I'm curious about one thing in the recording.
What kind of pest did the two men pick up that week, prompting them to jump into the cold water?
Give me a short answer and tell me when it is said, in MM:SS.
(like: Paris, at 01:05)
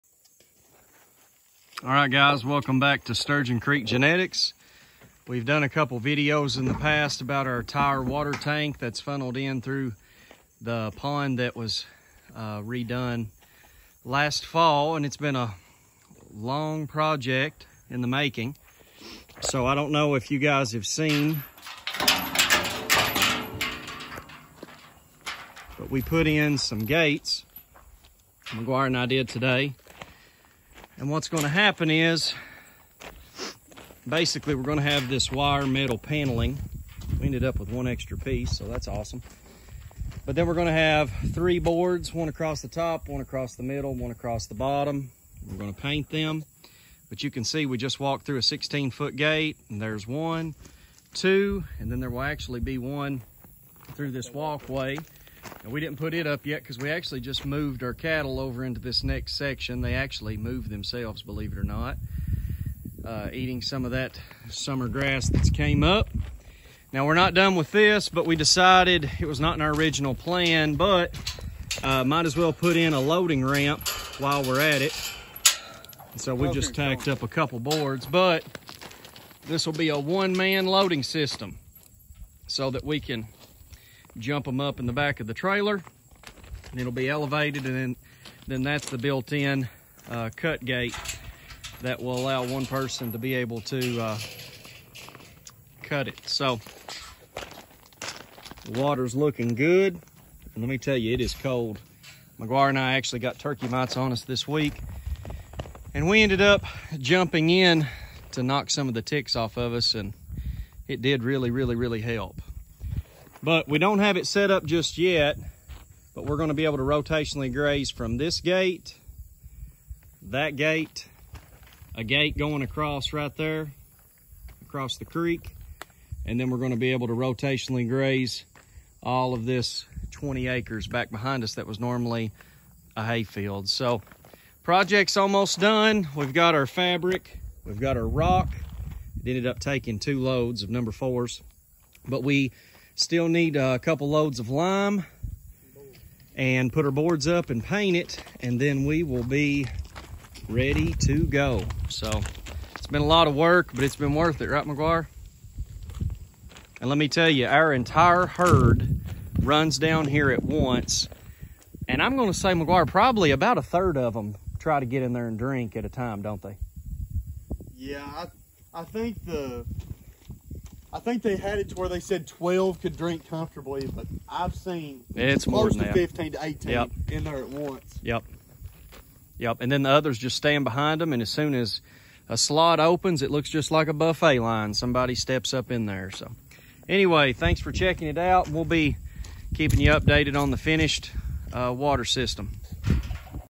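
turkey mites, at 01:43.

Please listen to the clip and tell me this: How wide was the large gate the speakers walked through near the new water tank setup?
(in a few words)
16-foot.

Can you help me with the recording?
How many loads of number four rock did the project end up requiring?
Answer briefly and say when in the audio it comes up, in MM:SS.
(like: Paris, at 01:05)
2, at 02:19.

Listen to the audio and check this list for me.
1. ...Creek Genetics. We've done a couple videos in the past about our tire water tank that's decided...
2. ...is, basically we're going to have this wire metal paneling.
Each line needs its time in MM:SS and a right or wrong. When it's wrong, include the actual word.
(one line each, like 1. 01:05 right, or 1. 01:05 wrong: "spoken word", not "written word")
1. 00:03 wrong: "funneled", not "decided"
2. 00:31 right.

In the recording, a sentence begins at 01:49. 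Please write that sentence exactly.
And it did really, really, really help.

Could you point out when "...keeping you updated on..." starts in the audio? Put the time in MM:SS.
03:09.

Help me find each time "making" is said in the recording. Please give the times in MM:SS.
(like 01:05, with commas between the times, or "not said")
00:18.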